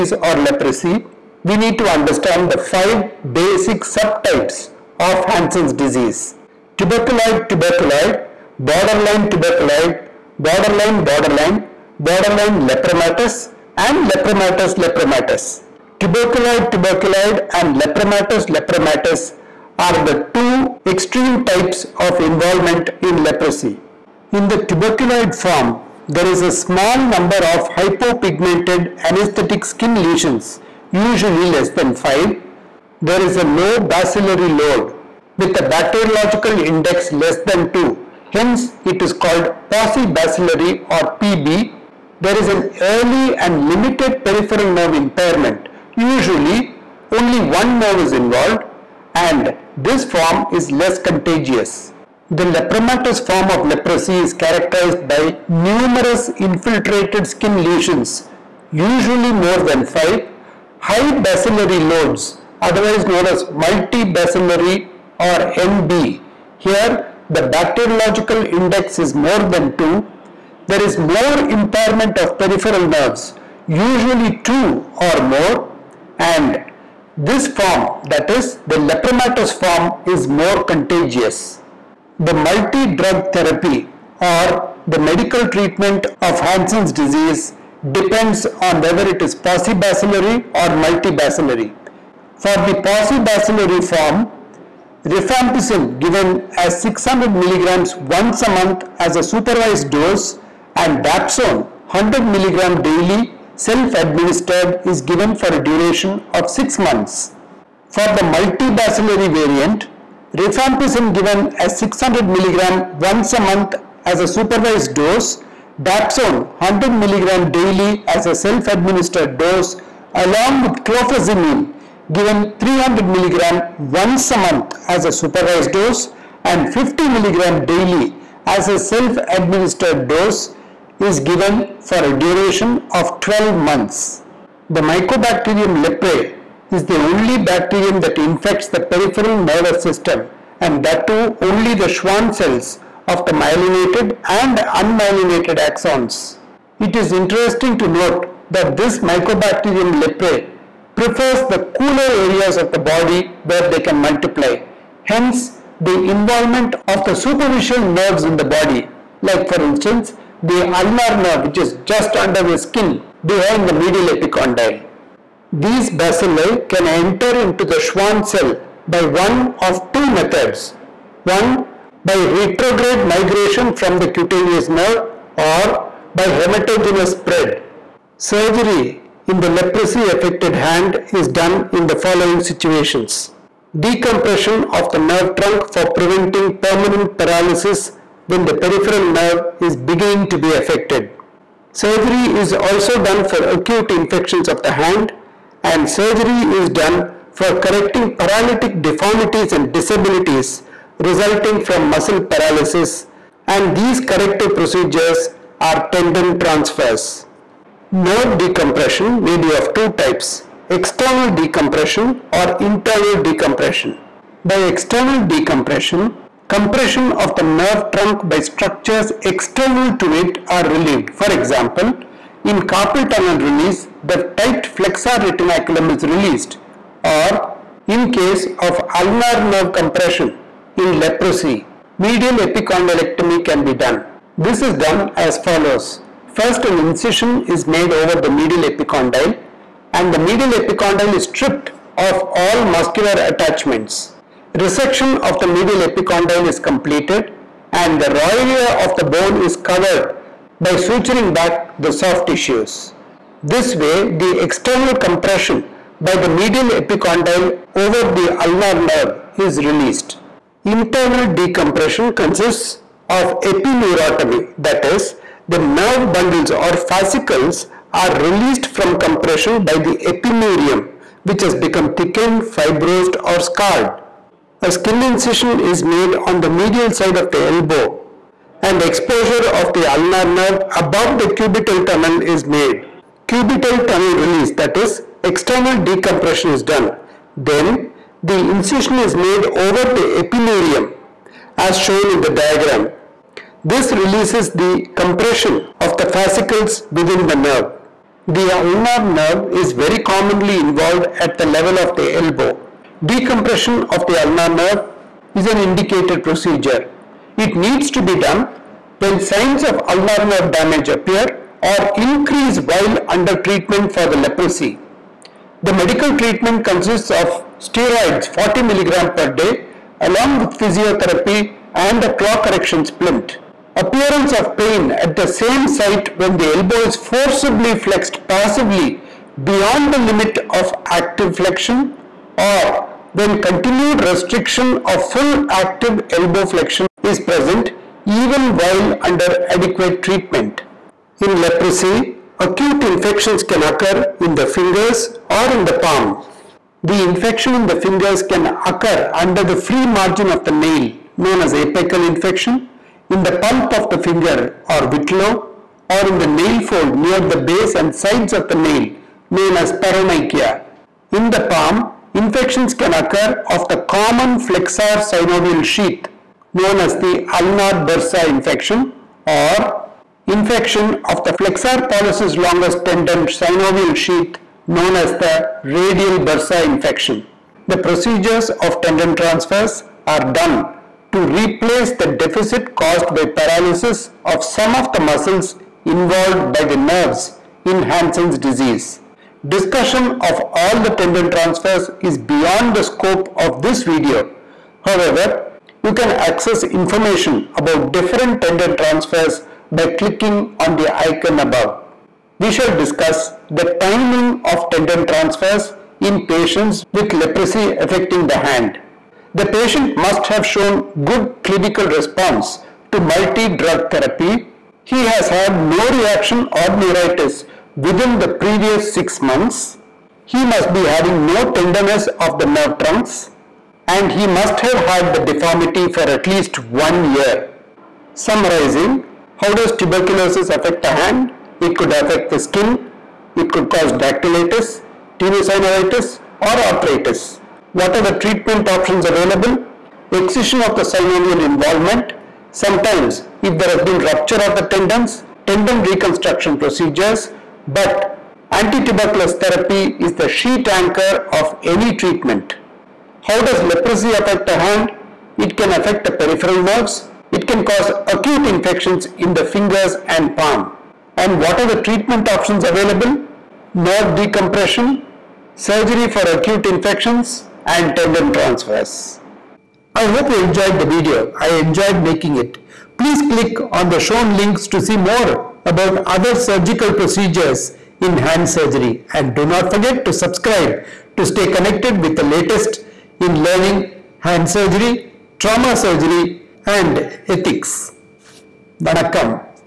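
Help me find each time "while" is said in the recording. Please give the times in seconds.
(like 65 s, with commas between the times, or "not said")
312 s, 338 s.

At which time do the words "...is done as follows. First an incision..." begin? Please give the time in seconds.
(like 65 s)
234 s.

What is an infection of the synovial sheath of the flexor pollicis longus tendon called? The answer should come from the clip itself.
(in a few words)
Radial bursa infection.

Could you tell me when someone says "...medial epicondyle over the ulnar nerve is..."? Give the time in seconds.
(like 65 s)
256 s.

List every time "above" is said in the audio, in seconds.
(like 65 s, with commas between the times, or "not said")
280 s, 401 s.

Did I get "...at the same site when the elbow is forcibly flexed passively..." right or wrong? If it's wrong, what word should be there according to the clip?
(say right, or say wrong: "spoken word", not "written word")
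right.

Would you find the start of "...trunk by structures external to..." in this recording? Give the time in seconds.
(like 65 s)
217 s.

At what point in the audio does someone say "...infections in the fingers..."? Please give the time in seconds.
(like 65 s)
458 s.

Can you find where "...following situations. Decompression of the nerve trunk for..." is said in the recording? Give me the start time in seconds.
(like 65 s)
181 s.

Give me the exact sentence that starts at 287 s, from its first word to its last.
Then the incision is made over the epineurium as shown in the diagram.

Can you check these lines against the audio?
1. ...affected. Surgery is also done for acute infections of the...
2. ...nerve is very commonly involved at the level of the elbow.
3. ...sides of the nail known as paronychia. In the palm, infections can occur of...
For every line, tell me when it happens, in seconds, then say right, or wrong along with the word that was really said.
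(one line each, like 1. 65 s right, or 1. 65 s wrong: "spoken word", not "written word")
1. 190 s right
2. 299 s right
3. 358 s right.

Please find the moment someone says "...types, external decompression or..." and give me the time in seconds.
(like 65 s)
210 s.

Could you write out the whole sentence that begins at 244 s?
Resection of the medial epicondyle is completed and the area of the bone is covered by suturing back the soft tissues.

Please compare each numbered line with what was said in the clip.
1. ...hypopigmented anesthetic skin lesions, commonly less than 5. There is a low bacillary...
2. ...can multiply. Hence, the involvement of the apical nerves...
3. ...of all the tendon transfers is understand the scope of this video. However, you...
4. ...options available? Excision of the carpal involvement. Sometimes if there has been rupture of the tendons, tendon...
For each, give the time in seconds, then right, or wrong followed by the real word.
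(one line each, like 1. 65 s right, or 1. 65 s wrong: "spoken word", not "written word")
1. 27 s wrong: "usually", not "commonly"
2. 153 s wrong: "superficial", not "apical"
3. 390 s wrong: "beyond", not "understand"
4. 438 s wrong: "synovial", not "carpal".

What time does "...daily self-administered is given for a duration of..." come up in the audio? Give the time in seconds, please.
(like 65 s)
102 s.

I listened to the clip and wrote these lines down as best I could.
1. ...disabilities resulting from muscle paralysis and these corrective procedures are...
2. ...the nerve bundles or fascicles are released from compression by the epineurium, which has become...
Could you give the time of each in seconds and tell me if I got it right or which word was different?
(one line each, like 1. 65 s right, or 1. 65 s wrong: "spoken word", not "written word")
1. 199 s right
2. 265 s right.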